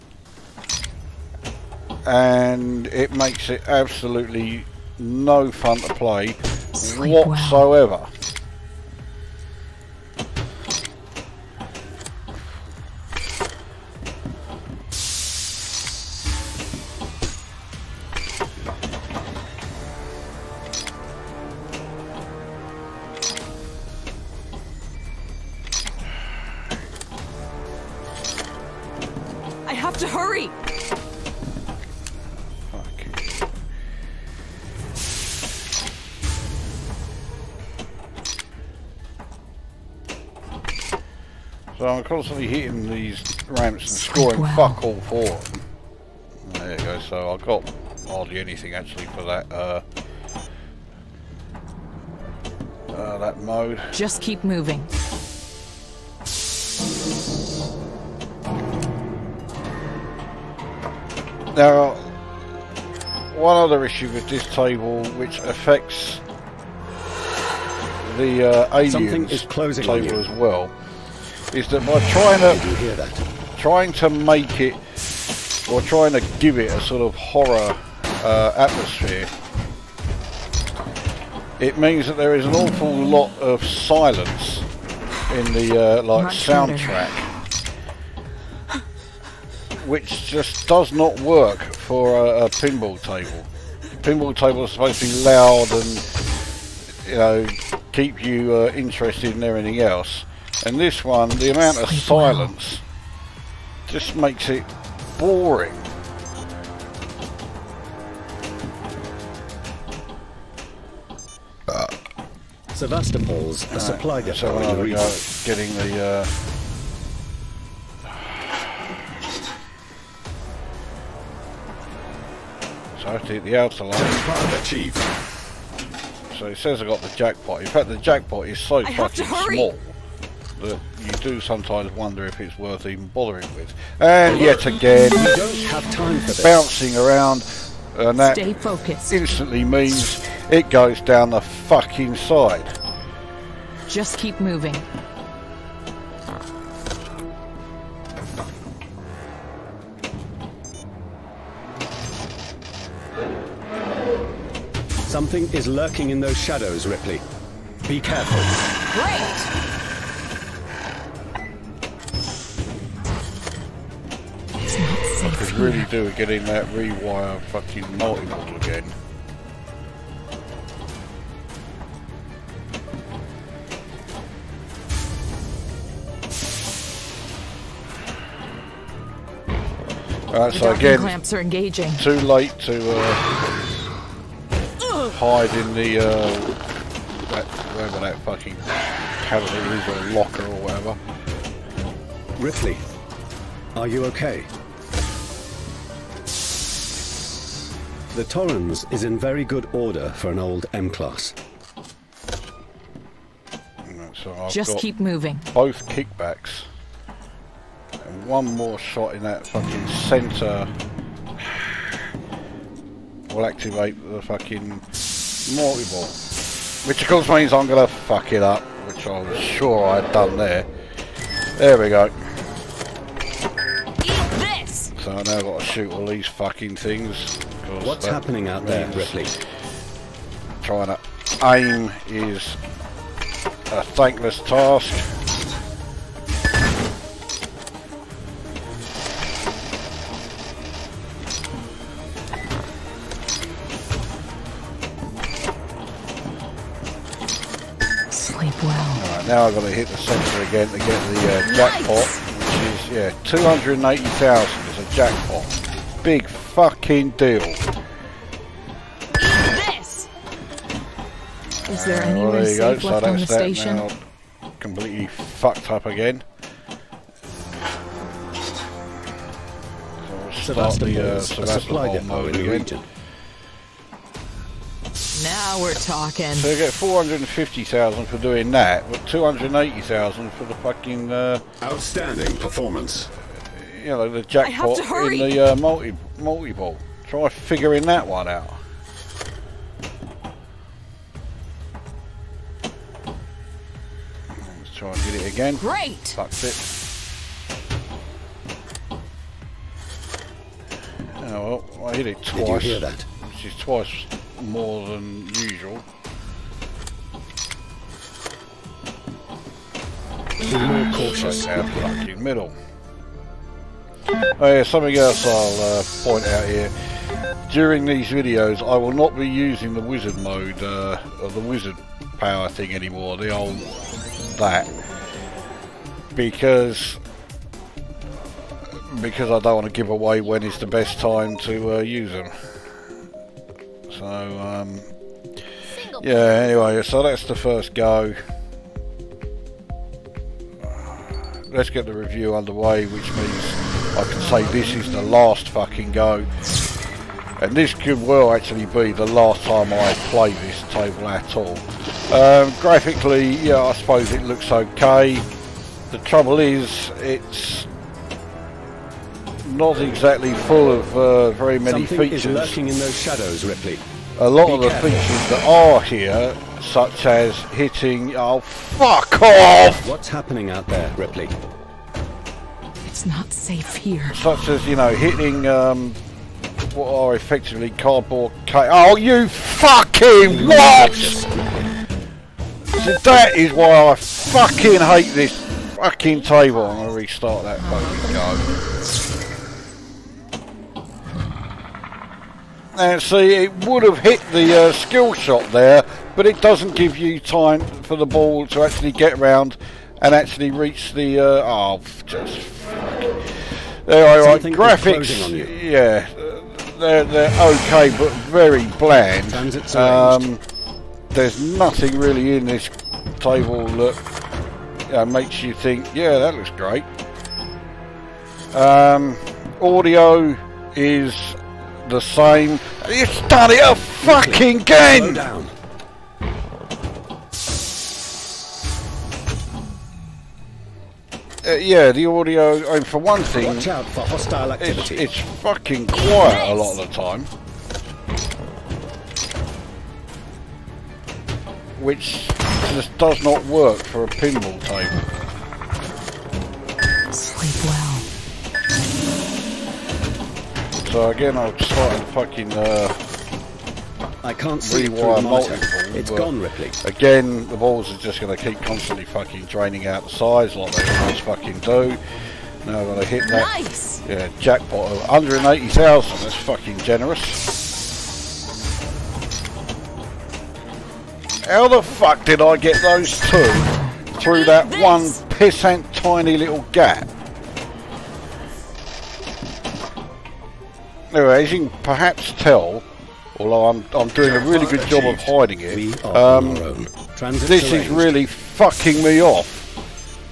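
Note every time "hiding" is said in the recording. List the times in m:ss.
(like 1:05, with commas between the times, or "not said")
8:05.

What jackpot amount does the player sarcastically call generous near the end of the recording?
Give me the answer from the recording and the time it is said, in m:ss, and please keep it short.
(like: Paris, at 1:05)
180,000, at 7:45.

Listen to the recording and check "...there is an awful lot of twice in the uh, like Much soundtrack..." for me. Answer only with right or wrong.
wrong.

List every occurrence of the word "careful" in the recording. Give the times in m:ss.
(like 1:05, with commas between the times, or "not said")
2:37, 6:04.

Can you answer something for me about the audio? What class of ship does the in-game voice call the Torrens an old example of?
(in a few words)
M-Class.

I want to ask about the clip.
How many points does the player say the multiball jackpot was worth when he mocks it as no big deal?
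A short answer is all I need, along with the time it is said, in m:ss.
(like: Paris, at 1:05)
280,000, at 4:13.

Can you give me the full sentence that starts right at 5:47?
And this could well actually be the last time I play this table at all.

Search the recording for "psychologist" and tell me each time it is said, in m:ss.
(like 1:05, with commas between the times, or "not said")
not said.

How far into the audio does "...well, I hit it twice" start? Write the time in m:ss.
5:01.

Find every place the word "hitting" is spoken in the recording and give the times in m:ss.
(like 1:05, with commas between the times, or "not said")
0:42, 6:07, 6:14.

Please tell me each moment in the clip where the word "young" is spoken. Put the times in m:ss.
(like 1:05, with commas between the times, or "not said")
not said.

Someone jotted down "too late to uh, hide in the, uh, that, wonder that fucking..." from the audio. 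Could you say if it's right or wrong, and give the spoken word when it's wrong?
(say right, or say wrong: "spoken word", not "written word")
wrong: "whatever", not "wonder".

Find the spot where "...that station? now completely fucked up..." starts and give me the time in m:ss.
4:23.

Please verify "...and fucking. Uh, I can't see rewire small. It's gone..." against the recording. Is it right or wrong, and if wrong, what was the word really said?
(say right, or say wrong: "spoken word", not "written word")
wrong: "multiball", not "small".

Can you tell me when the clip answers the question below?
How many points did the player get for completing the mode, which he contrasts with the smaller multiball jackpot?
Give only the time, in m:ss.
4:36.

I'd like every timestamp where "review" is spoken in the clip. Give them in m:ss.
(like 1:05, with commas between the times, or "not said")
5:41.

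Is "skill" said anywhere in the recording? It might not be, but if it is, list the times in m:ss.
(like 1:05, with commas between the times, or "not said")
6:34.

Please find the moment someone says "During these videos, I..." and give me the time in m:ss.
5:17.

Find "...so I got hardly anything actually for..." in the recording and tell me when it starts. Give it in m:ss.
0:46.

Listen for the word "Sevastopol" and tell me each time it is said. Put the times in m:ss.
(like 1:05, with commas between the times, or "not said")
1:52.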